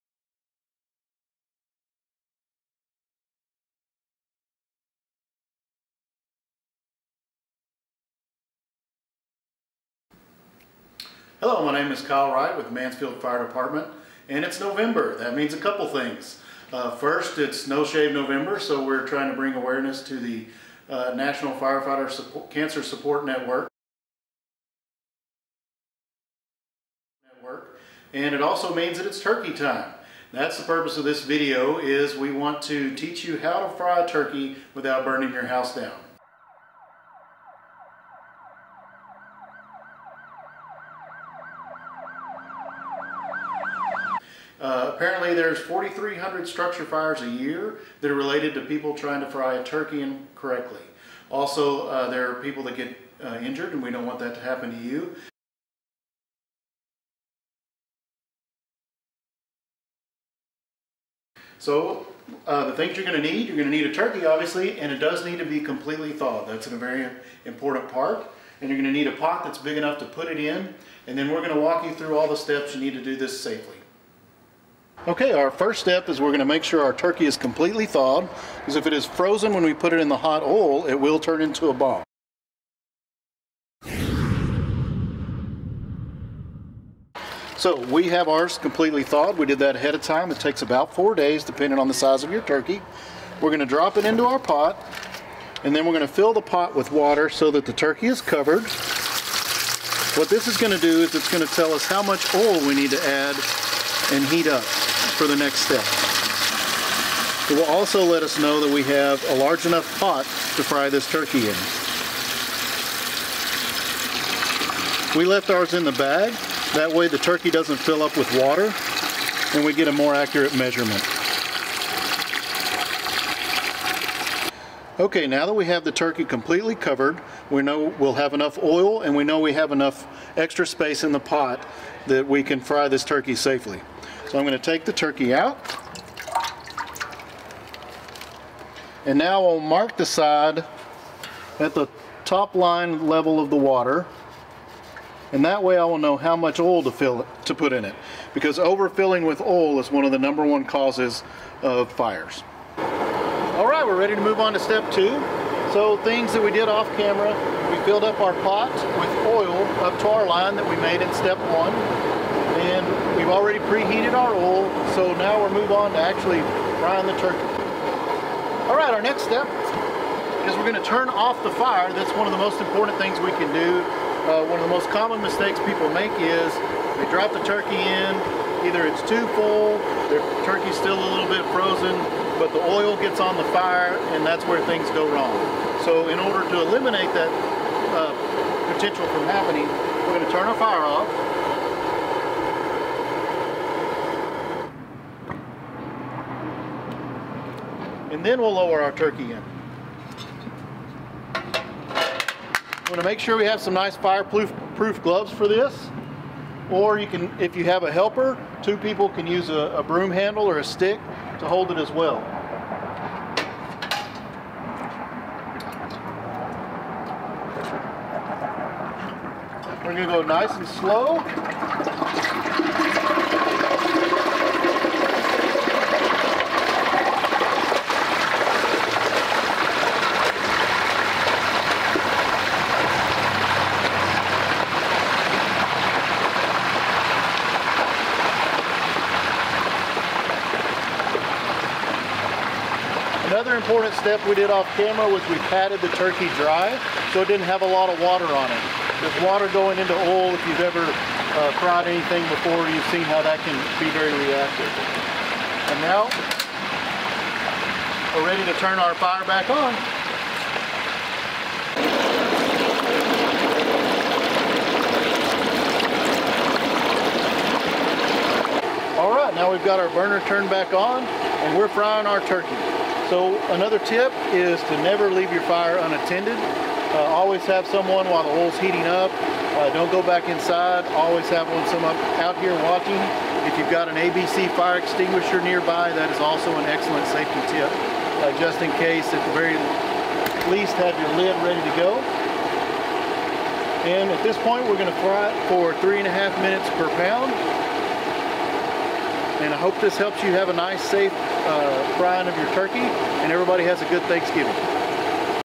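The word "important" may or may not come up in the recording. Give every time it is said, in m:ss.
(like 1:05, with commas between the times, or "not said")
1:07, 2:52, 4:03.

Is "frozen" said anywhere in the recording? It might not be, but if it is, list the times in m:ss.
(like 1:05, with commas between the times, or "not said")
1:19, 3:01.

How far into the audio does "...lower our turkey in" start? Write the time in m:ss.
3:18.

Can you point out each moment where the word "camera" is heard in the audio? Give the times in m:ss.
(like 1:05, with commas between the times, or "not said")
2:36, 4:04.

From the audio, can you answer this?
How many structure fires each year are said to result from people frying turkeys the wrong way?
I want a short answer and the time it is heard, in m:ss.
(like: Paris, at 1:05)
4,300, at 0:45.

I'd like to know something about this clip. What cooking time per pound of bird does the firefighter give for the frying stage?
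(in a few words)
3.5 minutes.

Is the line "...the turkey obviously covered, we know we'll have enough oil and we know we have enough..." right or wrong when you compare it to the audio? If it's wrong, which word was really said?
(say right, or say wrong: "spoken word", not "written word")
wrong: "completely", not "obviously".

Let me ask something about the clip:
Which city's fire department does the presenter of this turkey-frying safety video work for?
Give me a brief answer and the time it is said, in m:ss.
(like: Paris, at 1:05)
Mansfield, at 0:12.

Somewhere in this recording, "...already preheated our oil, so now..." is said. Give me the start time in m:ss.
2:43.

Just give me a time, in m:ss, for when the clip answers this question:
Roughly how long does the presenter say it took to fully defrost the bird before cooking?
1:30.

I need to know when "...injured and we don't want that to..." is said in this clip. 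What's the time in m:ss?
0:53.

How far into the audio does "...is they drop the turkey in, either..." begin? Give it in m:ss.
2:56.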